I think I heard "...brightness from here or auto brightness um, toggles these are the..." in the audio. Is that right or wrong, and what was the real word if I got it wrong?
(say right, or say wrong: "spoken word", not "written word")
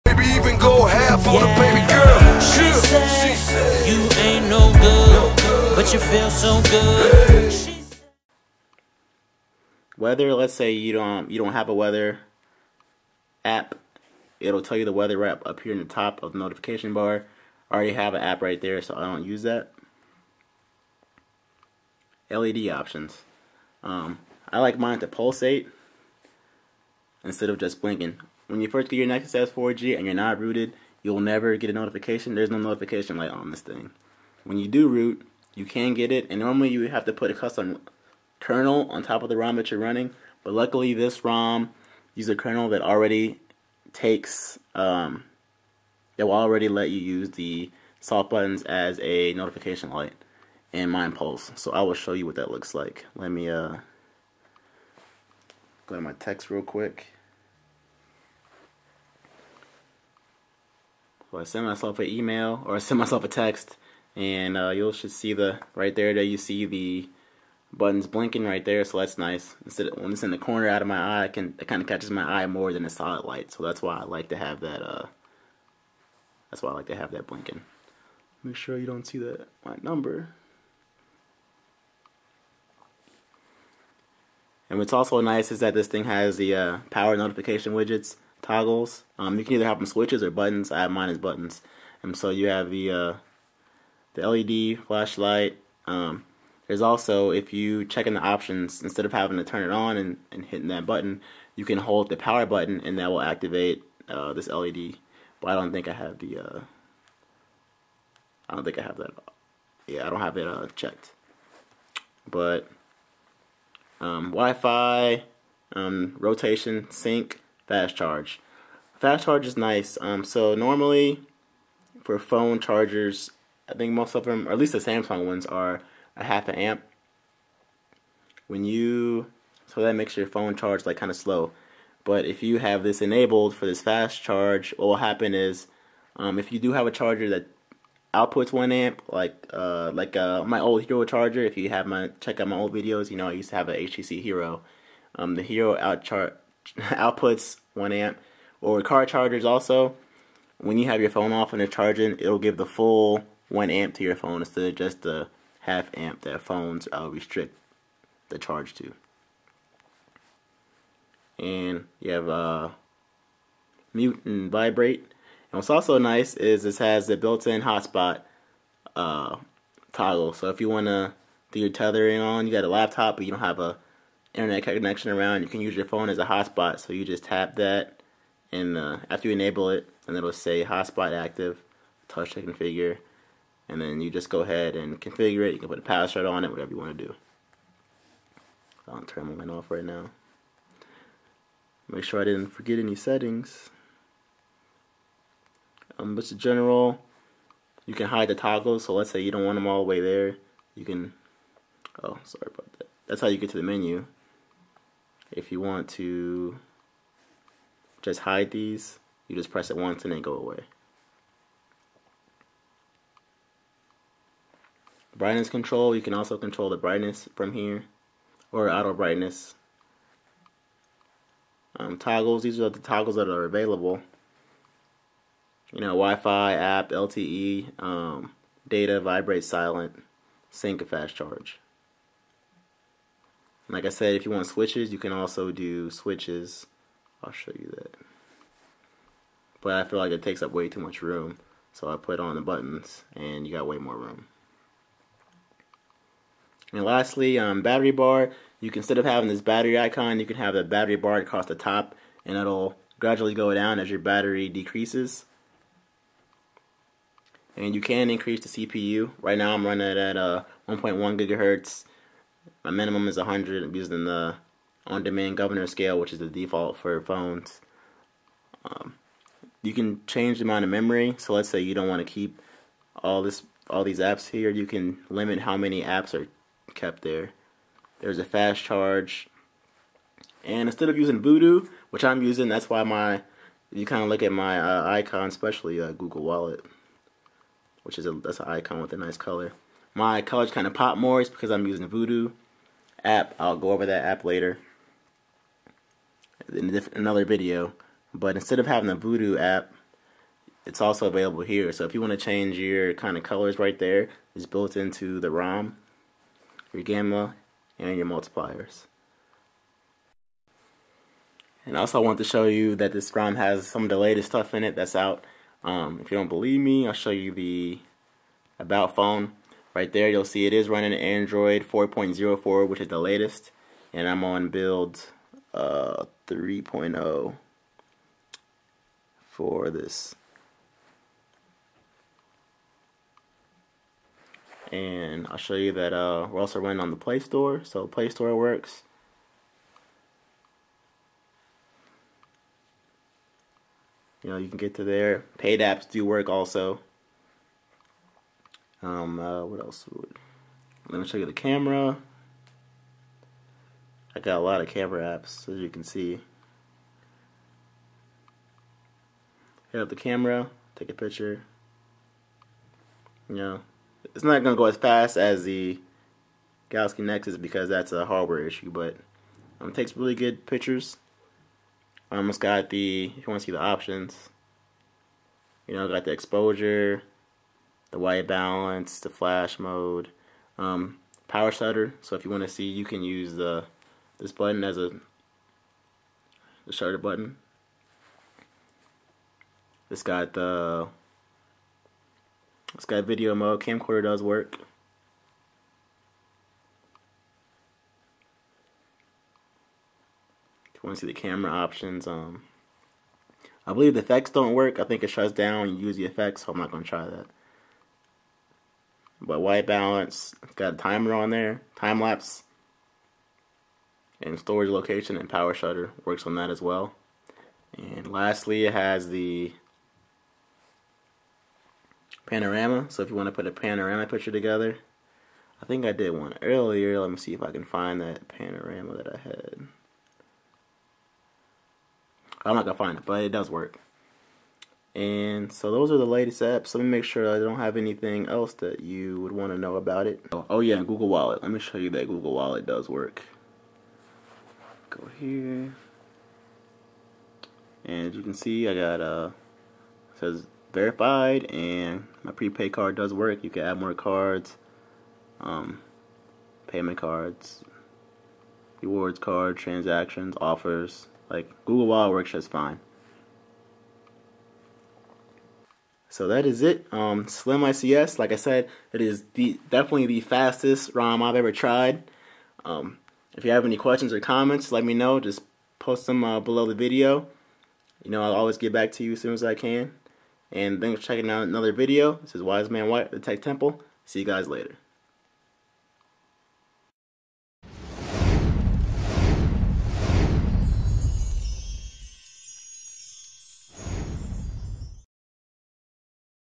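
right.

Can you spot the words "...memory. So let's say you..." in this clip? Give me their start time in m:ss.
4:30.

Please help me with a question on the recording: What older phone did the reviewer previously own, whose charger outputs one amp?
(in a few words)
HTC Hero.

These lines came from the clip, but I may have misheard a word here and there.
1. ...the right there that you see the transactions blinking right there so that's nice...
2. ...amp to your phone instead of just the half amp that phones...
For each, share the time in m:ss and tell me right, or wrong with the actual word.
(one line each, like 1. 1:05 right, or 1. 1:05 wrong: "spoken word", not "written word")
1. 1:05 wrong: "buttons", not "transactions"
2. 2:33 right.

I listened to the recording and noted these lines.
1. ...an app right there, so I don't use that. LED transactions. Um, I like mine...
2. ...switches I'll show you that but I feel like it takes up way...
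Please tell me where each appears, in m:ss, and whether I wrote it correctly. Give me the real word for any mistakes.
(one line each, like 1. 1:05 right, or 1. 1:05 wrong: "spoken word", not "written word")
1. 0:18 wrong: "options", not "transactions"
2. 3:55 right.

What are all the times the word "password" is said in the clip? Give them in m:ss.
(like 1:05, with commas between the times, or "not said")
3:05.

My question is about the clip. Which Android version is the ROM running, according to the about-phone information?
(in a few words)
Android 4.04.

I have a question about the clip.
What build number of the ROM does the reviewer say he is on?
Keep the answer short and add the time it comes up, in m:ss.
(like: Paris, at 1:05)
3.0, at 5:26.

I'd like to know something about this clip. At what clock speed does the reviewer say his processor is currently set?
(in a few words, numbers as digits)
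1.1 gigahertz.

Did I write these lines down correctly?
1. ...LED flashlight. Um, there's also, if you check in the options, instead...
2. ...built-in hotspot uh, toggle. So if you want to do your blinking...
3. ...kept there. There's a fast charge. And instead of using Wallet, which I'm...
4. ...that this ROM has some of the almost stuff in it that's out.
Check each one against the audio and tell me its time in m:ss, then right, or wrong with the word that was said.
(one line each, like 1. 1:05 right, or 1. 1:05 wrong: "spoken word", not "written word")
1. 1:34 right
2. 2:47 wrong: "tethering", not "blinking"
3. 4:36 wrong: "Voodoo", not "Wallet"
4. 5:12 wrong: "latest", not "almost".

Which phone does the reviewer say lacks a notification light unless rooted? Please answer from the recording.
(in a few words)
Nexus S4G.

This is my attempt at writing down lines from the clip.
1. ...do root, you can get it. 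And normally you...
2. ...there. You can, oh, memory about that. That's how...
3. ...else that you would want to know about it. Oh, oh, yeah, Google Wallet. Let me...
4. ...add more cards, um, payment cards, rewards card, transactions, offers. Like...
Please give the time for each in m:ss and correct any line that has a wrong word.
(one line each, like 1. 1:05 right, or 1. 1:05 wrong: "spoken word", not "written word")
1. 0:34 right
2. 3:20 wrong: "sorry", not "memory"
3. 7:18 right
4. 7:33 right.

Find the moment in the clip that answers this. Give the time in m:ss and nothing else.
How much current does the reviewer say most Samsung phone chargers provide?
2:06.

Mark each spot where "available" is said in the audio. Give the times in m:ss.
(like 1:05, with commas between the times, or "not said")
3:43, 5:01.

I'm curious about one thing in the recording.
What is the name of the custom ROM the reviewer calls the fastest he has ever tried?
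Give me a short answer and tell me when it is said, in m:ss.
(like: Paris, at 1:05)
Slim ICS, at 7:47.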